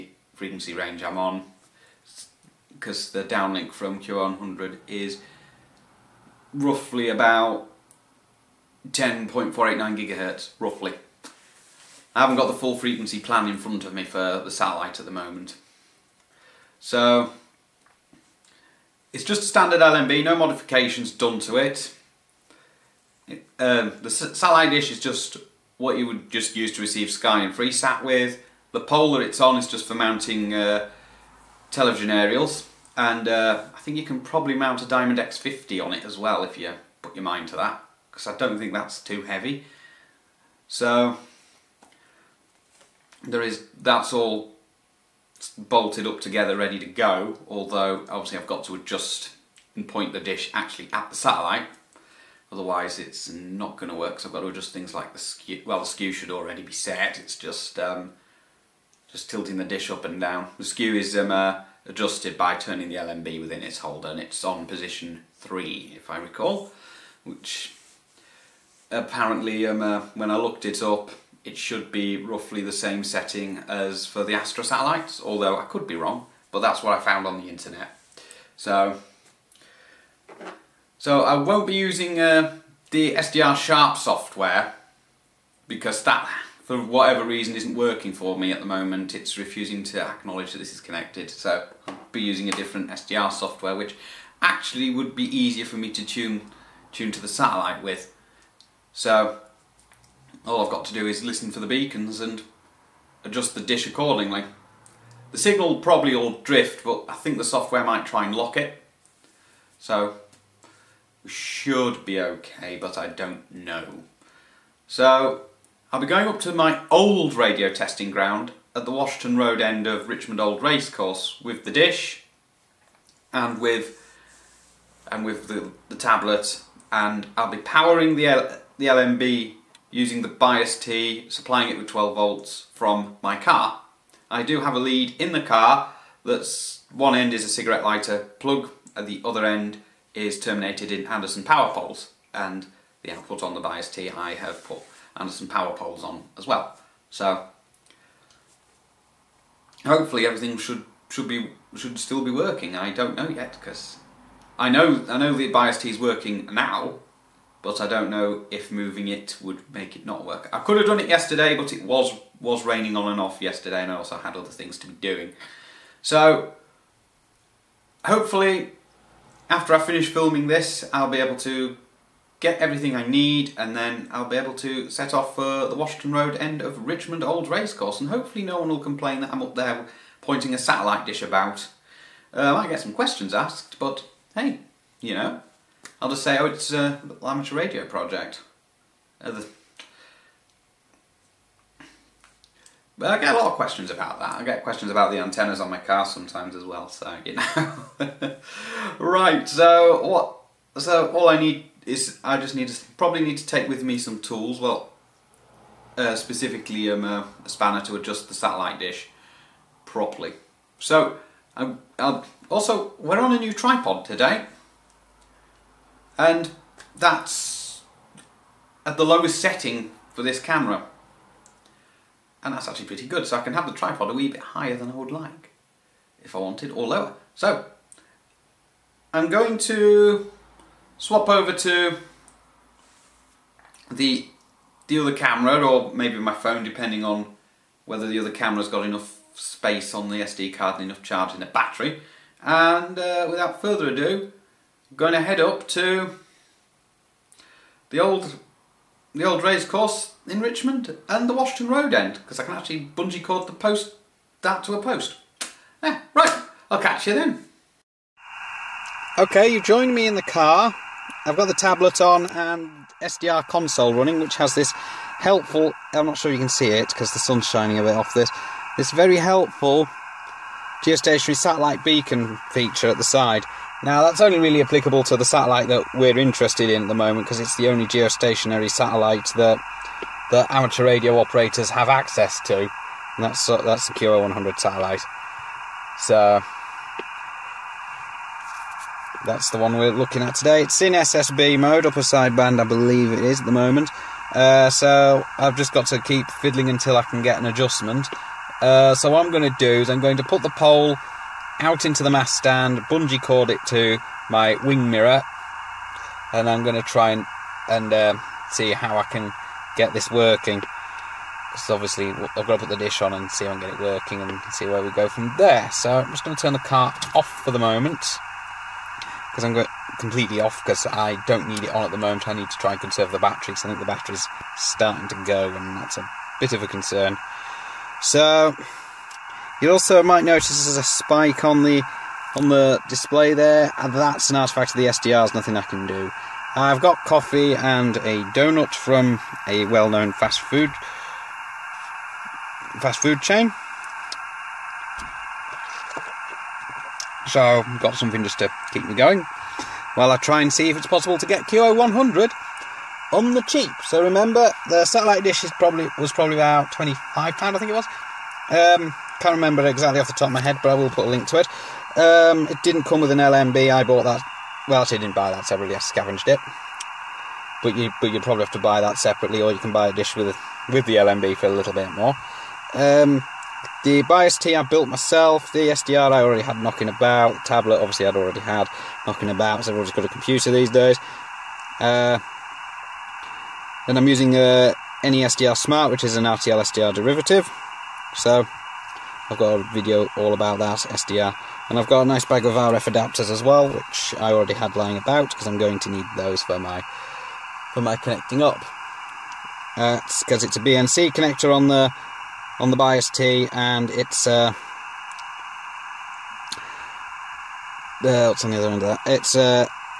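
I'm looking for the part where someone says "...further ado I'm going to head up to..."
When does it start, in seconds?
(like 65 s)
243 s.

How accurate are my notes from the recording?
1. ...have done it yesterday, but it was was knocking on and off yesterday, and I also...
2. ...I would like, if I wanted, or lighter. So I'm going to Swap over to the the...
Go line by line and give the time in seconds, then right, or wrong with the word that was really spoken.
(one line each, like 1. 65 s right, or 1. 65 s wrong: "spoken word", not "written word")
1. 160 s wrong: "raining", not "knocking"
2. 224 s wrong: "lower", not "lighter".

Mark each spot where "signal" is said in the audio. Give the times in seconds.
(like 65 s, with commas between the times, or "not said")
105 s.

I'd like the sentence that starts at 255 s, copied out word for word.
Yeah, right, I'll catch you then.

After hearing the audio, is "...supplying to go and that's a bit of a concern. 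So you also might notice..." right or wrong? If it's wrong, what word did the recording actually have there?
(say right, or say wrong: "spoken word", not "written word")
wrong: "starting", not "supplying".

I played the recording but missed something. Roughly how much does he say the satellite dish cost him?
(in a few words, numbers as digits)
£25.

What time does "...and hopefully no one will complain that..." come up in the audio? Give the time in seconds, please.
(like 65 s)
178 s.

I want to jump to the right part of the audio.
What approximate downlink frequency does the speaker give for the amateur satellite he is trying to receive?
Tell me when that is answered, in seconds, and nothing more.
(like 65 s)
8 s.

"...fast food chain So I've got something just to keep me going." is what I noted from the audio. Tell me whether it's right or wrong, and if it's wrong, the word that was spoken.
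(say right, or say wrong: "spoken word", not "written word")
right.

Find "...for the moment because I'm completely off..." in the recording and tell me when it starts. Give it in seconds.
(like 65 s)
317 s.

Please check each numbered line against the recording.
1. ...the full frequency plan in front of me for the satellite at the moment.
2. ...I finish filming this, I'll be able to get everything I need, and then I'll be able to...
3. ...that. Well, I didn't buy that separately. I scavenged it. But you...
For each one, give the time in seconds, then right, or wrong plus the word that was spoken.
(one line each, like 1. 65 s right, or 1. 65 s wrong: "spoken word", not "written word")
1. 12 s right
2. 169 s right
3. 364 s right.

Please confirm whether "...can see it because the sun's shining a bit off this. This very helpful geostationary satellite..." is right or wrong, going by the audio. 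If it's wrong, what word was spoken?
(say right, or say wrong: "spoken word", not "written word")
right.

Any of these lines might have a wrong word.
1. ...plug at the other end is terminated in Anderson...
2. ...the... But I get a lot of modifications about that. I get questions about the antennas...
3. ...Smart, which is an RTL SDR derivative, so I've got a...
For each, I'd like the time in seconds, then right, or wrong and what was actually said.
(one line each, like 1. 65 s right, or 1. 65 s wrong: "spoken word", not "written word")
1. 138 s right
2. 189 s wrong: "questions", not "modifications"
3. 385 s right.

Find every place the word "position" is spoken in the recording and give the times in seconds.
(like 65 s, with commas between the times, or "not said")
64 s.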